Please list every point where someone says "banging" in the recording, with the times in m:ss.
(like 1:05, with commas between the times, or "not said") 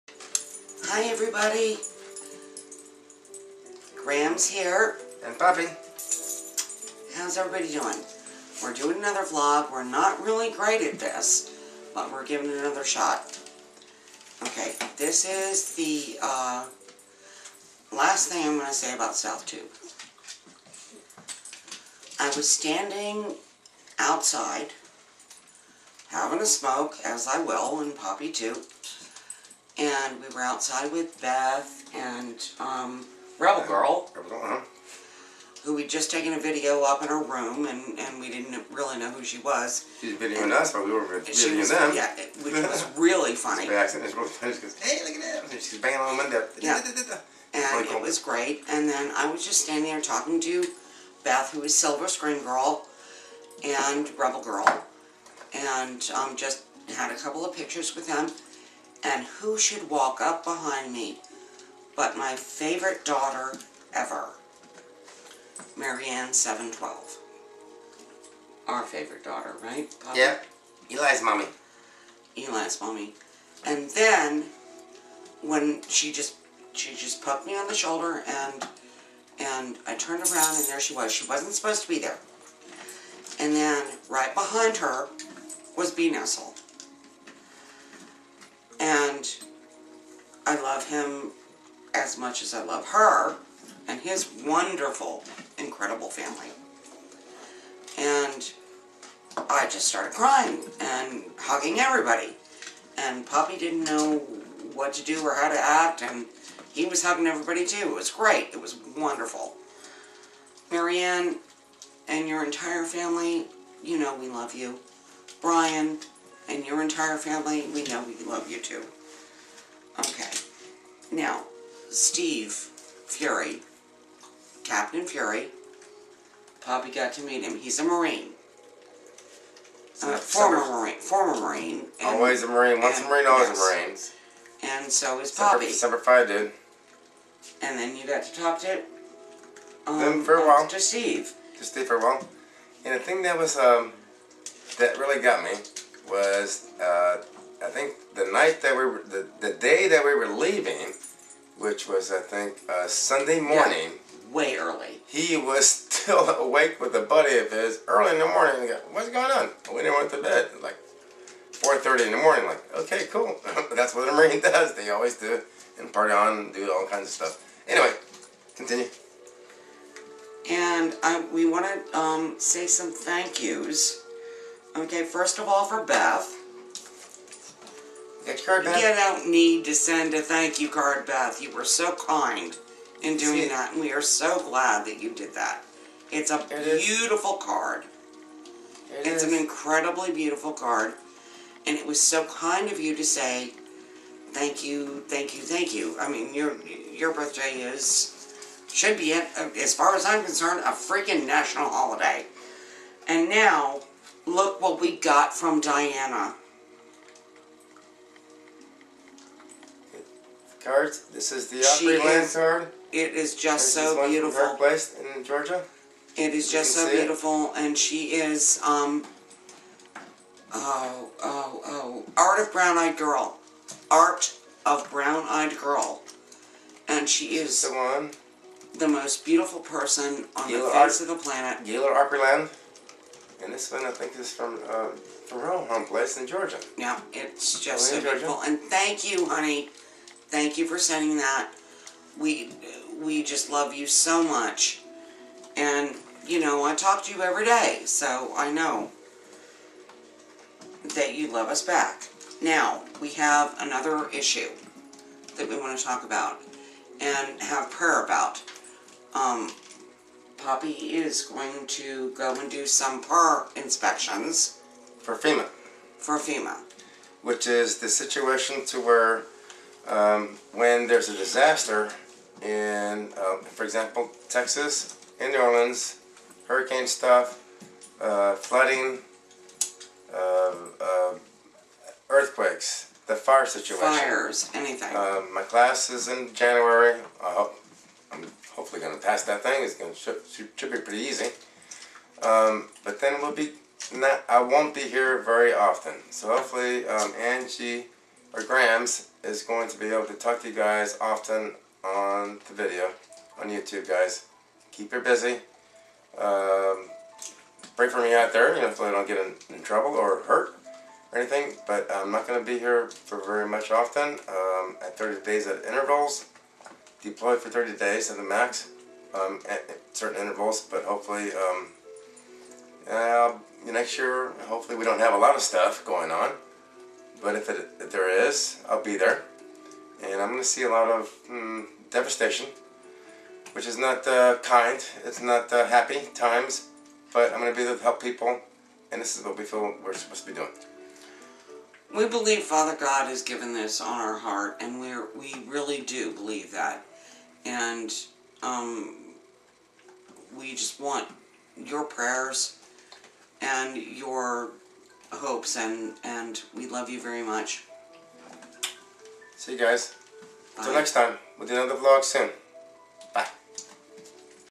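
0:45.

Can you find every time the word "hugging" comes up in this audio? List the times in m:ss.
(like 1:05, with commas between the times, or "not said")
1:41, 1:47.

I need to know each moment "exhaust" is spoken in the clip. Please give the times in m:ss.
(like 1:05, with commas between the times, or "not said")
not said.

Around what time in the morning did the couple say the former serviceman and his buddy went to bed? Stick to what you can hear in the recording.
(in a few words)
4:30.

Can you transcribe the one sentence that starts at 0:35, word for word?
who we'd just taken a video up in her room, and, and we didn't really know who she was.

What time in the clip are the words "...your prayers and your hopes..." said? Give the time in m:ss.
5:51.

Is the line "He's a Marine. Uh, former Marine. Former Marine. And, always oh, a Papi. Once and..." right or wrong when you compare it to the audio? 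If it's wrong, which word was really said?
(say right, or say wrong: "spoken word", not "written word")
wrong: "Marine", not "Papi".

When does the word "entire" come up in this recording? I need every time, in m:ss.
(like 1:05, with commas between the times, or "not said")
1:52, 1:56.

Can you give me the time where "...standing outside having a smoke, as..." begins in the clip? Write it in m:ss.
0:22.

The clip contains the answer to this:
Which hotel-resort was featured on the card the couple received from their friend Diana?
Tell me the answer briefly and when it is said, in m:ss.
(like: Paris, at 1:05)
Gaylord Opryland, at 3:51.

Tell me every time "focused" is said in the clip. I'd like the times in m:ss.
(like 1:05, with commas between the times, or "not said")
not said.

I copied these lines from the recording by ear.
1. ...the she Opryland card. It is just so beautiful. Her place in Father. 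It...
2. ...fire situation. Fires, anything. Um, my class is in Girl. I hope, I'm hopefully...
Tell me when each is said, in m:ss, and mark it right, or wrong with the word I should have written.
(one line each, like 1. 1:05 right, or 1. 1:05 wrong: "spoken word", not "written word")
1. 3:31 wrong: "Georgia", not "Father"
2. 4:43 wrong: "January", not "Girl".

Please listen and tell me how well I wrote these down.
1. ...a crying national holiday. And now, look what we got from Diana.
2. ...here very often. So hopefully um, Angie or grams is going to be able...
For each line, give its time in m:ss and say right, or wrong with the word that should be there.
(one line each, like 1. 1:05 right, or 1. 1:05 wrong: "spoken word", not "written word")
1. 3:20 wrong: "freaking", not "crying"
2. 4:54 right.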